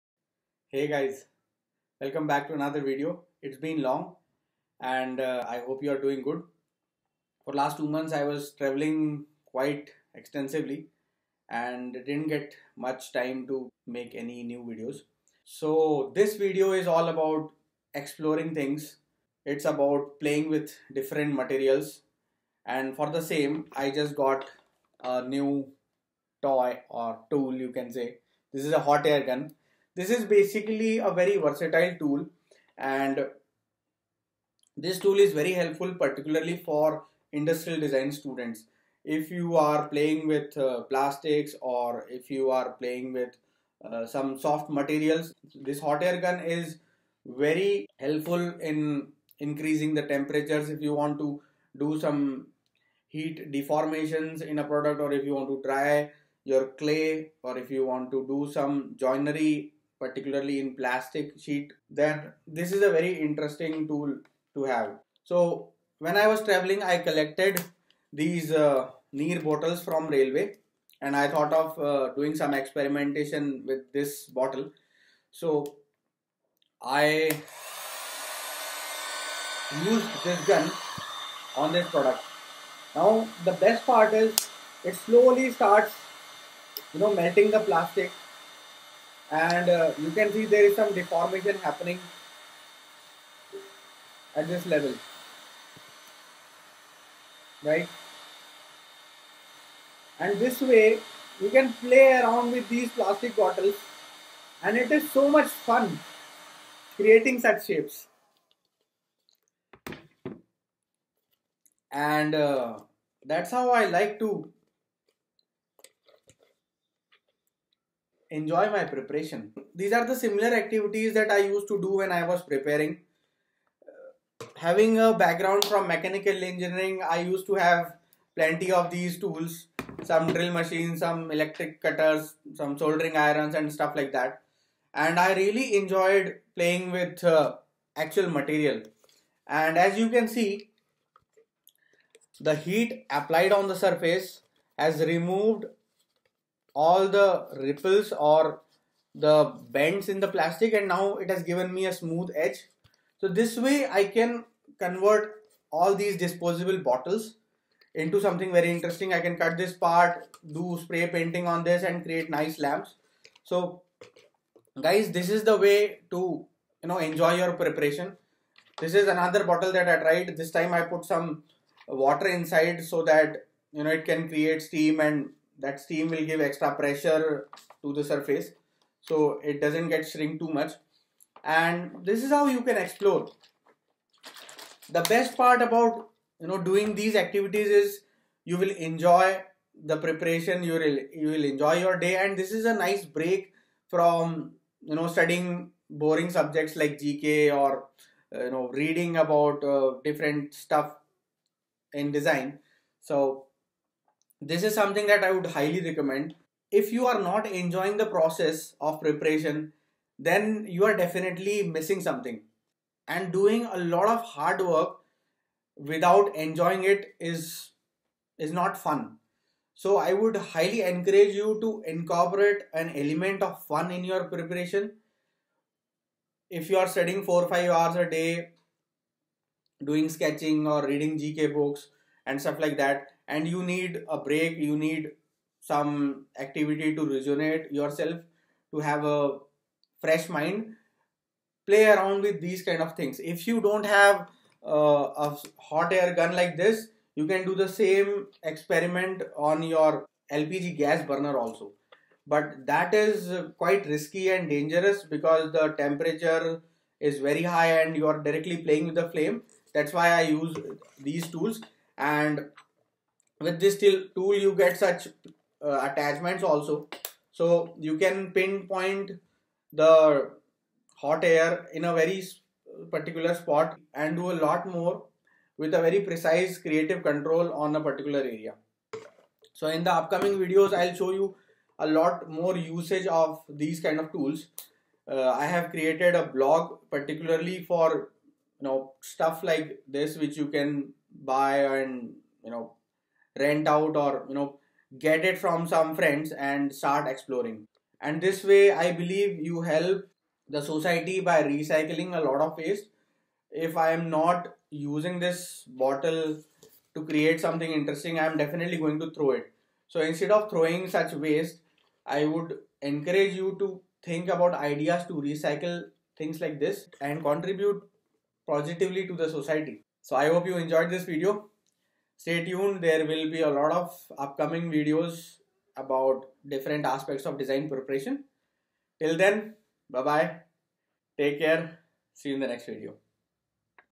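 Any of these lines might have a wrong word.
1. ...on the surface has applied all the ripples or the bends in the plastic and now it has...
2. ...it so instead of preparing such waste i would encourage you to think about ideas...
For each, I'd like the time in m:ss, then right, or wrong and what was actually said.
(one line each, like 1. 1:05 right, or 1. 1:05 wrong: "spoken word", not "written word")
1. 2:23 wrong: "removed", not "applied"
2. 5:09 wrong: "throwing", not "preparing".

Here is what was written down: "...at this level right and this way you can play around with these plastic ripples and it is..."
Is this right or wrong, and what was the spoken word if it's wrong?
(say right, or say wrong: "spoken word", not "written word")
wrong: "bottles", not "ripples".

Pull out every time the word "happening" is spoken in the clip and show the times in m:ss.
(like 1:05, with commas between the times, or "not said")
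1:31.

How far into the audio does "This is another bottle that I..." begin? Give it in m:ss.
2:48.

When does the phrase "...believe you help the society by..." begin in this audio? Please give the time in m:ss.
4:58.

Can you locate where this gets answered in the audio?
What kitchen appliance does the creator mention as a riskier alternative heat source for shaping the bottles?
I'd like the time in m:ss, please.
4:10.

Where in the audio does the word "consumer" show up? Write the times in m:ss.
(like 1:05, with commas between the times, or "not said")
not said.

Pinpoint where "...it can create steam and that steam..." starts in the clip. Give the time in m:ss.
2:53.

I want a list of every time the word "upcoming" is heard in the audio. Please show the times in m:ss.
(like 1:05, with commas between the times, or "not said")
4:39, 5:24.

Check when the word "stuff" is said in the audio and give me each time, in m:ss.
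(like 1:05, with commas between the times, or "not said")
2:13, 3:20, 3:52, 4:49.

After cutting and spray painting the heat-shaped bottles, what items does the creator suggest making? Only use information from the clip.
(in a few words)
Lamps.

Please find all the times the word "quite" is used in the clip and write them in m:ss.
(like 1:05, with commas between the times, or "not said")
0:09, 4:13.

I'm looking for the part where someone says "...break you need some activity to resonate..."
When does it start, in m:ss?
3:54.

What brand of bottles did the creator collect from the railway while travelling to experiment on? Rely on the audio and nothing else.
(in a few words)
Neer.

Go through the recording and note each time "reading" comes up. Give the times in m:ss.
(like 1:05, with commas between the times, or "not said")
3:18, 3:50.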